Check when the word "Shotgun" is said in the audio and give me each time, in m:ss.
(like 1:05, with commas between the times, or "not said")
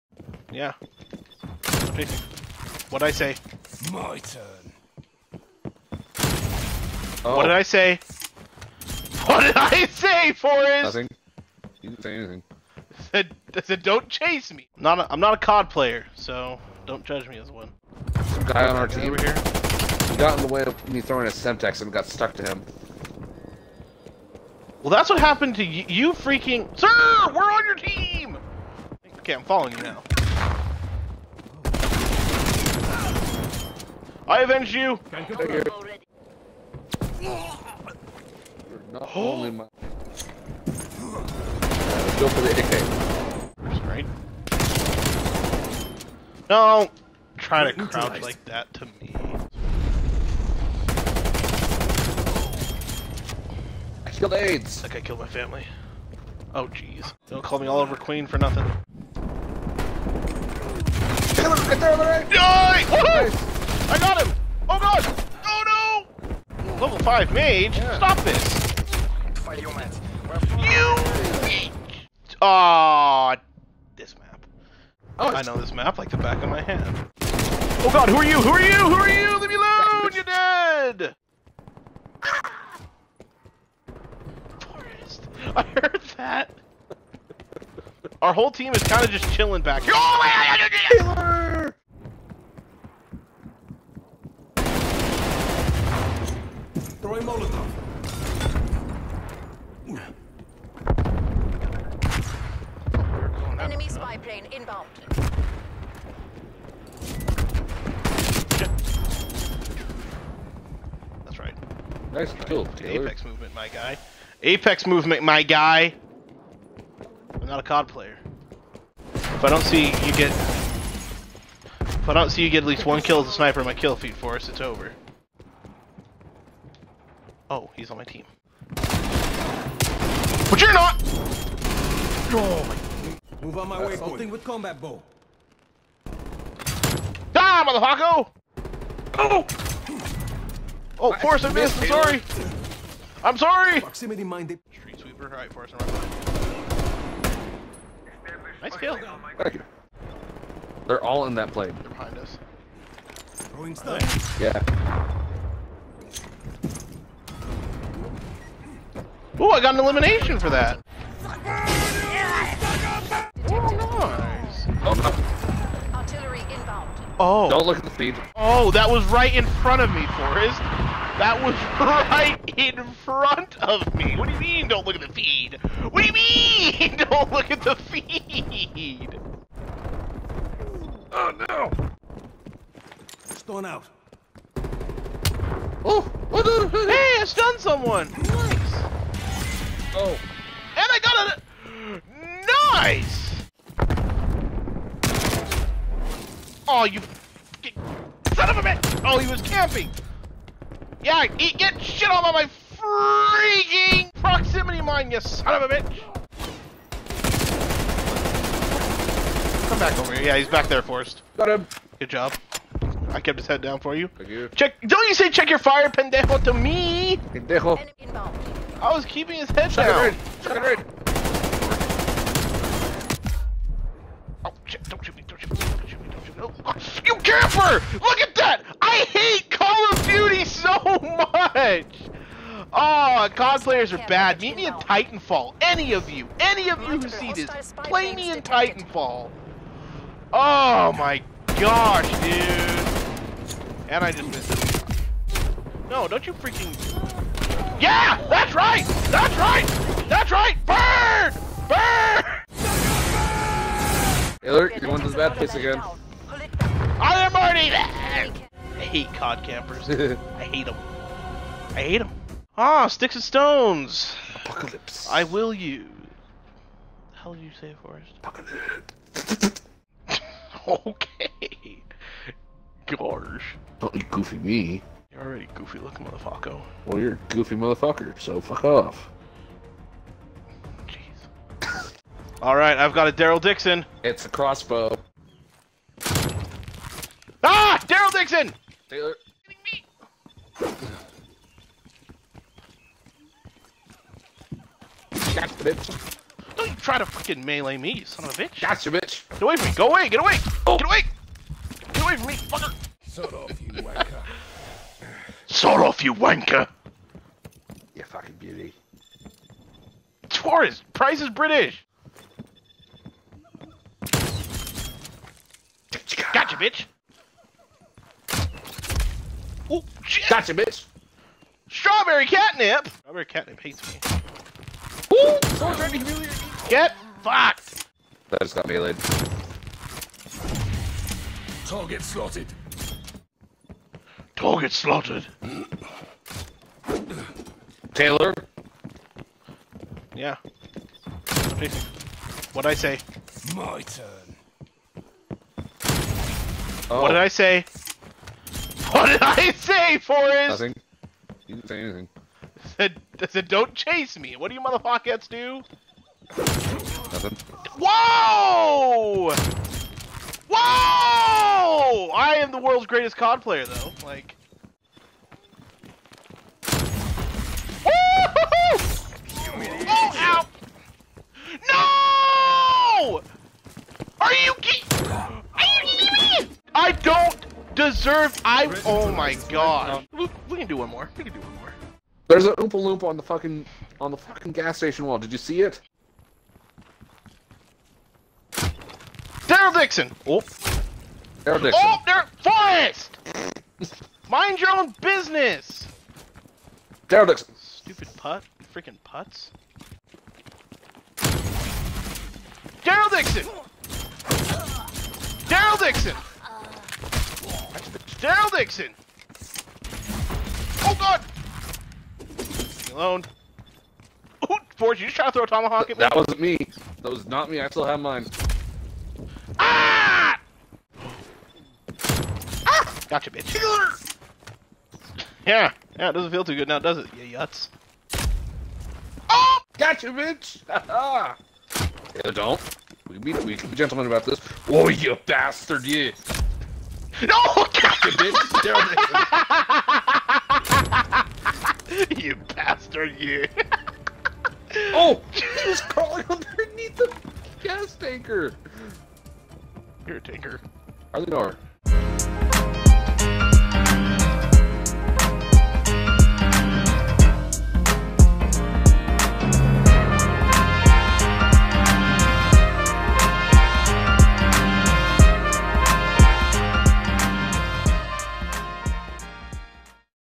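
3:40.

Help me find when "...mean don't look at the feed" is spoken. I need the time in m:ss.
2:54.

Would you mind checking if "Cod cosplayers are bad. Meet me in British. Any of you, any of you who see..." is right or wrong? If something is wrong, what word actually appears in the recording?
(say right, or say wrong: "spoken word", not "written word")
wrong: "Titanfall", not "British".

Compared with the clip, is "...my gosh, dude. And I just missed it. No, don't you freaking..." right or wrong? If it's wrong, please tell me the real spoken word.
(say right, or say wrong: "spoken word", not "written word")
right.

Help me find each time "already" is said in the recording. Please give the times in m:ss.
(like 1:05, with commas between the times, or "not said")
4:17, 4:35.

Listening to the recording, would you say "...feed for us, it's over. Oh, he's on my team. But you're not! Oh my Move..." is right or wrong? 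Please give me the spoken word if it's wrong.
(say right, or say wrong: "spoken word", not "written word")
right.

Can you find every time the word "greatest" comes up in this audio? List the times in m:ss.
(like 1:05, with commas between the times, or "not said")
6:02.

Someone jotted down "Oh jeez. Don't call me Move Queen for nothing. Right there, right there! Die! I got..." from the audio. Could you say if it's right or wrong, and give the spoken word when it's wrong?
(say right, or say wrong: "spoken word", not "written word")
wrong: "Oliver", not "Move".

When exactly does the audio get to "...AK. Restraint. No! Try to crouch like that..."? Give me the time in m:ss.
0:42.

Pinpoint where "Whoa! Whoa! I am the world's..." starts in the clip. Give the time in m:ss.
5:57.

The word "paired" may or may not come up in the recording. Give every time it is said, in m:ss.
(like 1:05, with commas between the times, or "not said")
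not said.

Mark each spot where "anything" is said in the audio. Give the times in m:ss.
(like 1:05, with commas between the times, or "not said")
0:12, 5:51.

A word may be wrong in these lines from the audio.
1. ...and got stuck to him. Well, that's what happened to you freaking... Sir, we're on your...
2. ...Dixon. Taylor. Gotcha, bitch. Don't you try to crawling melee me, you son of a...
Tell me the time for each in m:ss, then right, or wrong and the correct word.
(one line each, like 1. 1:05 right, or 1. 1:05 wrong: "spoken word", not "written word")
1. 0:21 right
2. 4:48 wrong: "fucking", not "crawling".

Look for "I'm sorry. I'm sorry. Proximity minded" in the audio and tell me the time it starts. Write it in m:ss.
2:21.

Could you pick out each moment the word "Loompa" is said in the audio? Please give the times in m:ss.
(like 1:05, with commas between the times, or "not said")
6:22.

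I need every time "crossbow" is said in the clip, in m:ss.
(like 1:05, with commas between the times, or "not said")
4:44.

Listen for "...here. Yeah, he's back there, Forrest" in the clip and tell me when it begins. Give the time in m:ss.
3:30.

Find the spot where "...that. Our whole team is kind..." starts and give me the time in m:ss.
1:26.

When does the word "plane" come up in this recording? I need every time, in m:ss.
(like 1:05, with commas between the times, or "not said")
1:44, 2:31.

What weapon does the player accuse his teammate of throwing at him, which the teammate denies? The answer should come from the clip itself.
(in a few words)
Tomahawk.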